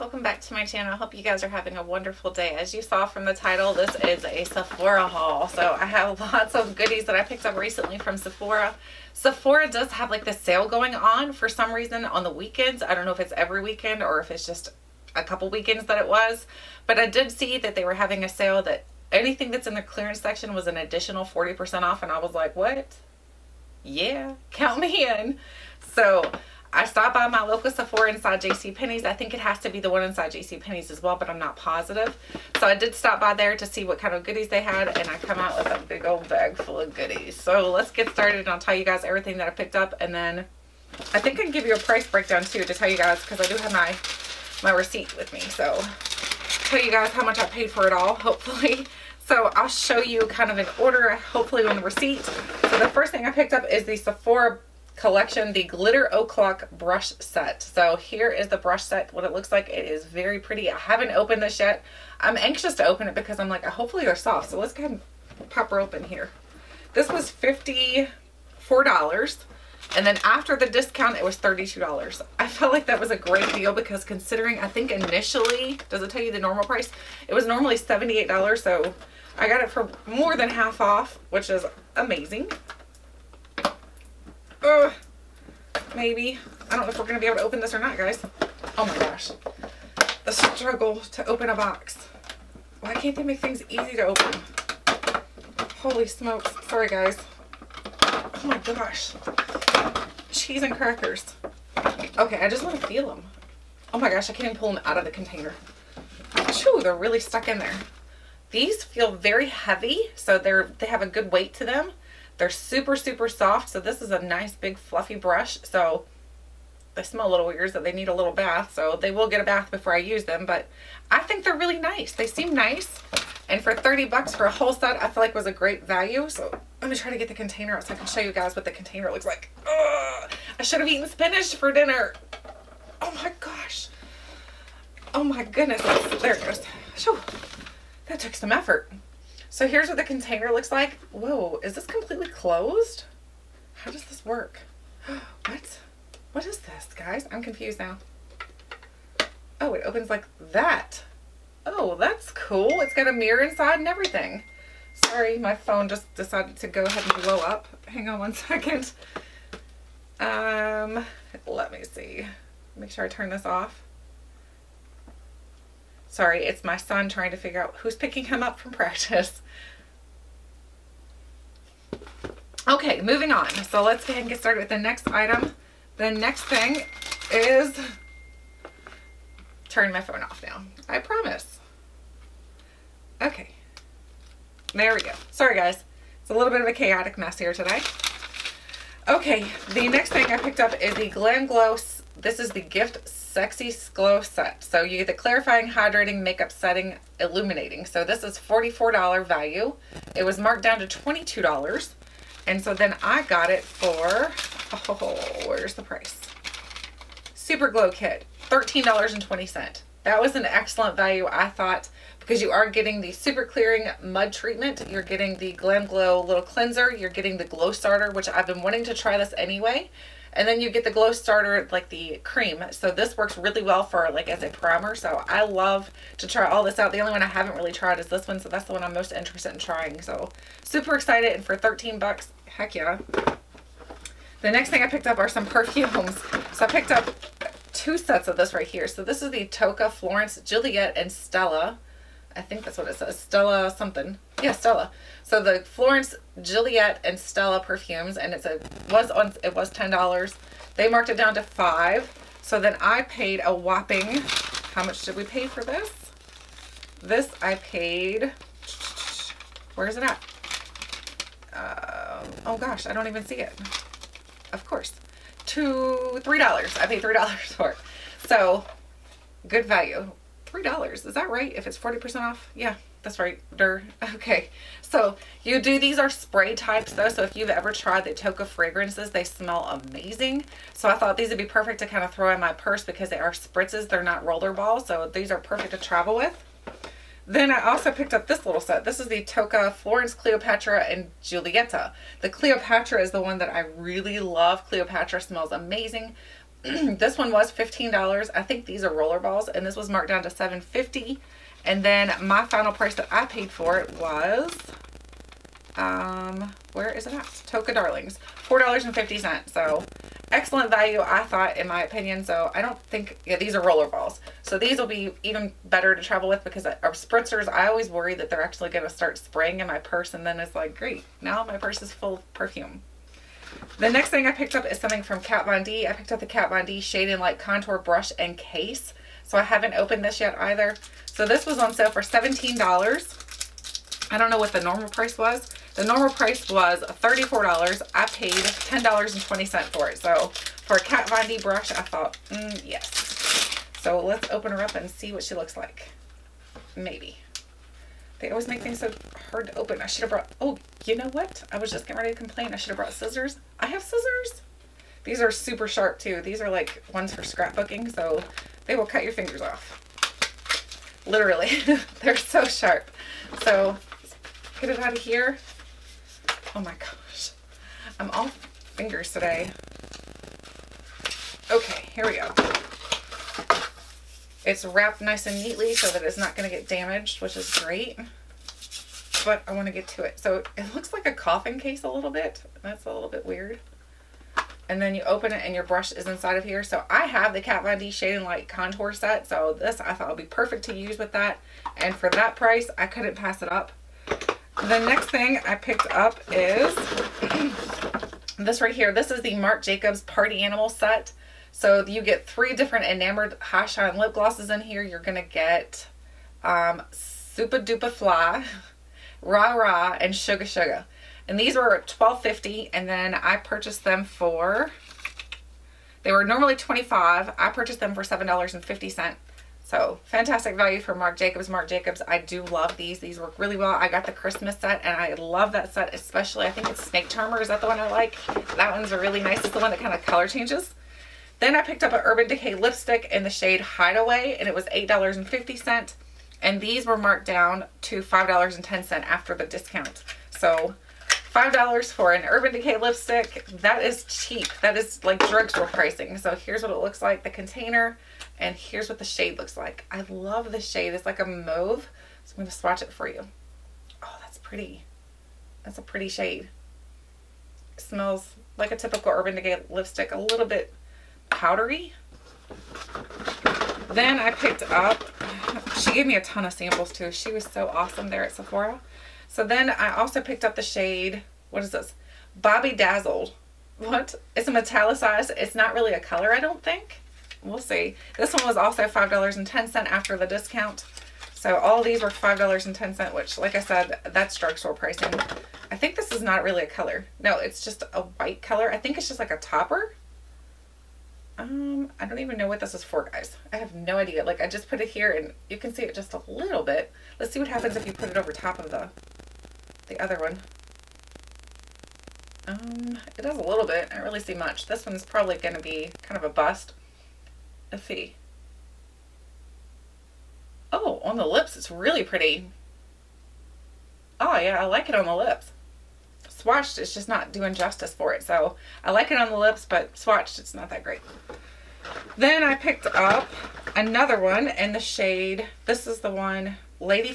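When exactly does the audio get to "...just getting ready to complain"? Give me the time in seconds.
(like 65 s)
351 s.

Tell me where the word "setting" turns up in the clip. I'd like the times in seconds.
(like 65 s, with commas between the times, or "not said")
196 s.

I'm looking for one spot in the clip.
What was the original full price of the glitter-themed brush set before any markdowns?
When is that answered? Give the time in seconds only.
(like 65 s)
77 s.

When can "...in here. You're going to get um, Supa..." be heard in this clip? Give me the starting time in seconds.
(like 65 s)
404 s.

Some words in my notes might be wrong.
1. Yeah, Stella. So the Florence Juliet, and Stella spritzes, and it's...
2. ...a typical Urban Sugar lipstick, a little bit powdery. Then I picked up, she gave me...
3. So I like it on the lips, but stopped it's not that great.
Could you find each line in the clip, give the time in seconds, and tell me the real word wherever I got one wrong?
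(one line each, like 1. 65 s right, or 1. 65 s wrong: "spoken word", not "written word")
1. 244 s wrong: "perfumes", not "spritzes"
2. 458 s wrong: "Decay", not "Sugar"
3. 518 s wrong: "swatched", not "stopped".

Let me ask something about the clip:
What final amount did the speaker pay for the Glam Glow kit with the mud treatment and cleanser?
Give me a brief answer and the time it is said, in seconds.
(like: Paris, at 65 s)
$13.20, at 208 s.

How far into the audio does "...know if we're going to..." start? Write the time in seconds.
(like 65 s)
86 s.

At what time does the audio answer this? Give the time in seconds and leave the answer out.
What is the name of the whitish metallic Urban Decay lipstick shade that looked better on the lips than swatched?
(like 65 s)
472 s.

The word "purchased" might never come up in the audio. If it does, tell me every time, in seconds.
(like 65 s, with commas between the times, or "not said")
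413 s, 417 s.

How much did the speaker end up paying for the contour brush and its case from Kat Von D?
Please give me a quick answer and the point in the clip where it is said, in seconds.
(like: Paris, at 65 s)
$10.20, at 337 s.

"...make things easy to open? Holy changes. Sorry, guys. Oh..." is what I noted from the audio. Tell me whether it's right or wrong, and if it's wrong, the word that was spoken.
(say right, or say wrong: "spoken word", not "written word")
wrong: "smokes", not "changes".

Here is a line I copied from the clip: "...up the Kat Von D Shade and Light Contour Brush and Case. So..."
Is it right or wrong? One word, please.
right.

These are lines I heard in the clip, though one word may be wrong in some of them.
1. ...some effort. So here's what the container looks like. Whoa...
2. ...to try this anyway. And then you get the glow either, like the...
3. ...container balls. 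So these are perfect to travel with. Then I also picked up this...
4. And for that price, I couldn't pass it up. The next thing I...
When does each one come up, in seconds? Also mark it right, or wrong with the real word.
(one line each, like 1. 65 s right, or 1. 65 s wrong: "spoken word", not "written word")
1. 138 s right
2. 218 s wrong: "starter", not "either"
3. 284 s wrong: "roller", not "container"
4. 391 s right.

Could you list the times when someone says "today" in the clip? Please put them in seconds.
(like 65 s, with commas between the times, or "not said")
187 s, 369 s.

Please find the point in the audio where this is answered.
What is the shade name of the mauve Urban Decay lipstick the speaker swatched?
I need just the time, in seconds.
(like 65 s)
433 s.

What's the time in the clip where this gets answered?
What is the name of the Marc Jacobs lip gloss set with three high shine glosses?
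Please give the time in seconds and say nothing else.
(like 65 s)
400 s.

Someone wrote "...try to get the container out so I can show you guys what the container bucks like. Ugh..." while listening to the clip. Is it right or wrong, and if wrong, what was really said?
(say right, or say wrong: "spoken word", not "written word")
wrong: "looks", not "bucks".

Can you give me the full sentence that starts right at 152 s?
It's got a mirror inside and everything.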